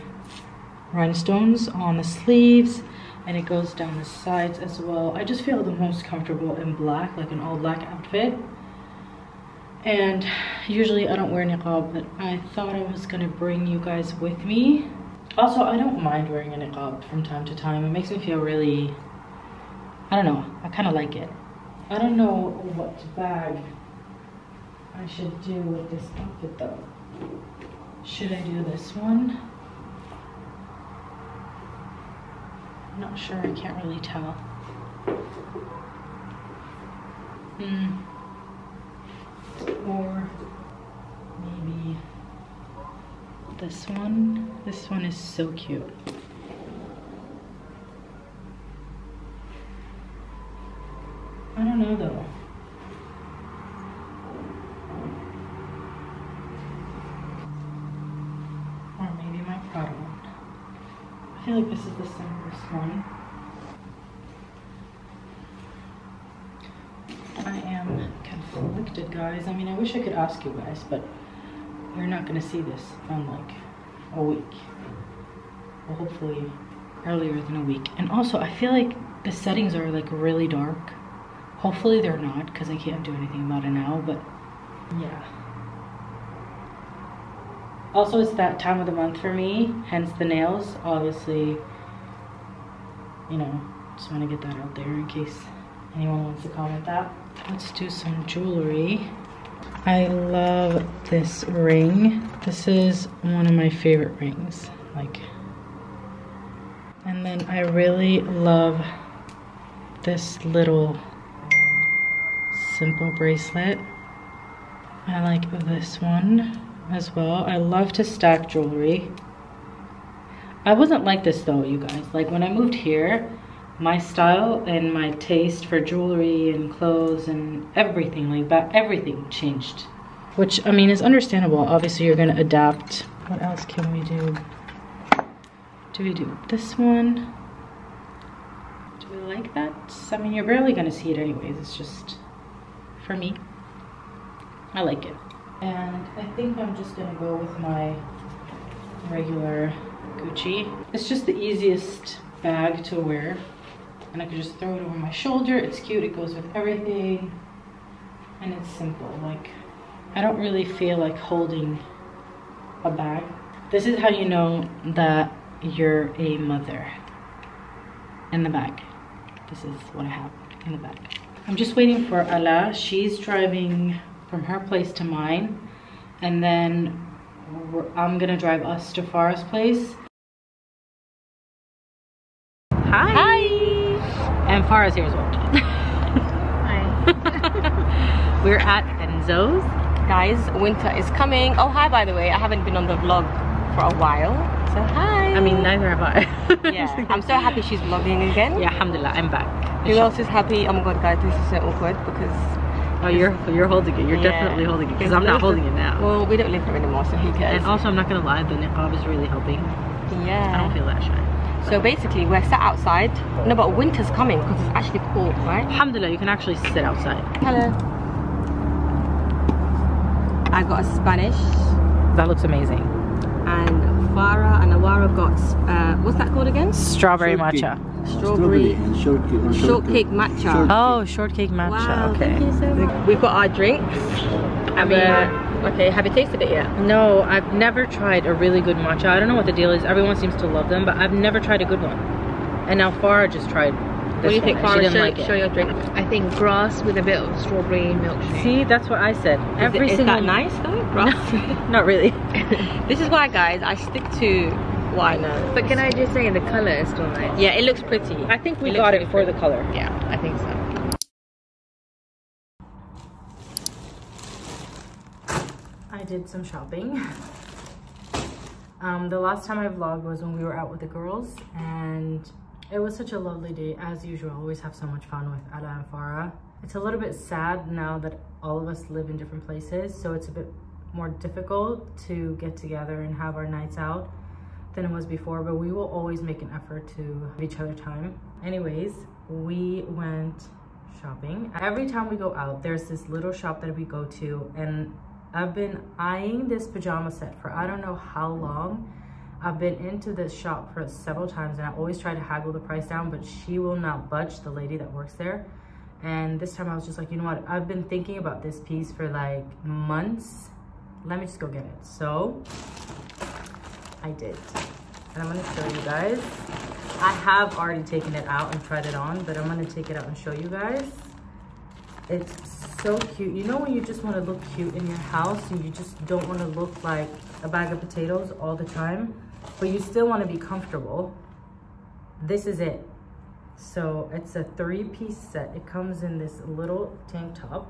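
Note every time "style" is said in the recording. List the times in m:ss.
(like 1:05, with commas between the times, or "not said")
2:03.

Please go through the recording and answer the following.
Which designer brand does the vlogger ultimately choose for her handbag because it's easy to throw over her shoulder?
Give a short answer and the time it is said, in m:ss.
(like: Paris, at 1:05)
Gucci, at 2:30.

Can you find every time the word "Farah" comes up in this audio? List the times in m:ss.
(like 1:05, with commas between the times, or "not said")
2:59, 3:04, 4:03, 4:35.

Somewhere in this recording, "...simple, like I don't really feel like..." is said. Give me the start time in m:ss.
2:38.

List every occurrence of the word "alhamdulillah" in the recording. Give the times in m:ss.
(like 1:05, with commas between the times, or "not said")
3:18, 3:35.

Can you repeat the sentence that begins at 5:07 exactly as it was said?
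I've been thinking about this piece for like months.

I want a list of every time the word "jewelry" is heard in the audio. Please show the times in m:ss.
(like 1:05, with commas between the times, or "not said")
1:38, 1:58, 2:05.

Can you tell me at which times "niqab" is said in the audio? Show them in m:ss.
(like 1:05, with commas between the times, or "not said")
0:11, 0:16, 3:28.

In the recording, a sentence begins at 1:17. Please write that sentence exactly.
And also, I feel like the settings are like really dark.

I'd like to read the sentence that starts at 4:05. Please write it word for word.
I think grass with a bit of strawberry milkshake.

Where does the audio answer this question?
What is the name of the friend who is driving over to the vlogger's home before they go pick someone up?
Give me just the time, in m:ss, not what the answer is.
2:52.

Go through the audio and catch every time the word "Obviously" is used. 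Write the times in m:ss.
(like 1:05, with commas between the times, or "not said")
1:30, 2:11.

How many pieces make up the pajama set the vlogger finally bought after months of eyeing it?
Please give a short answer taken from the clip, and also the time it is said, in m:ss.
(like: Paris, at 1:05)
3, at 5:34.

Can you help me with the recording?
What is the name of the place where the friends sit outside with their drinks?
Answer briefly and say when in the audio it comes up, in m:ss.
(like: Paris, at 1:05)
Enzo's, at 3:09.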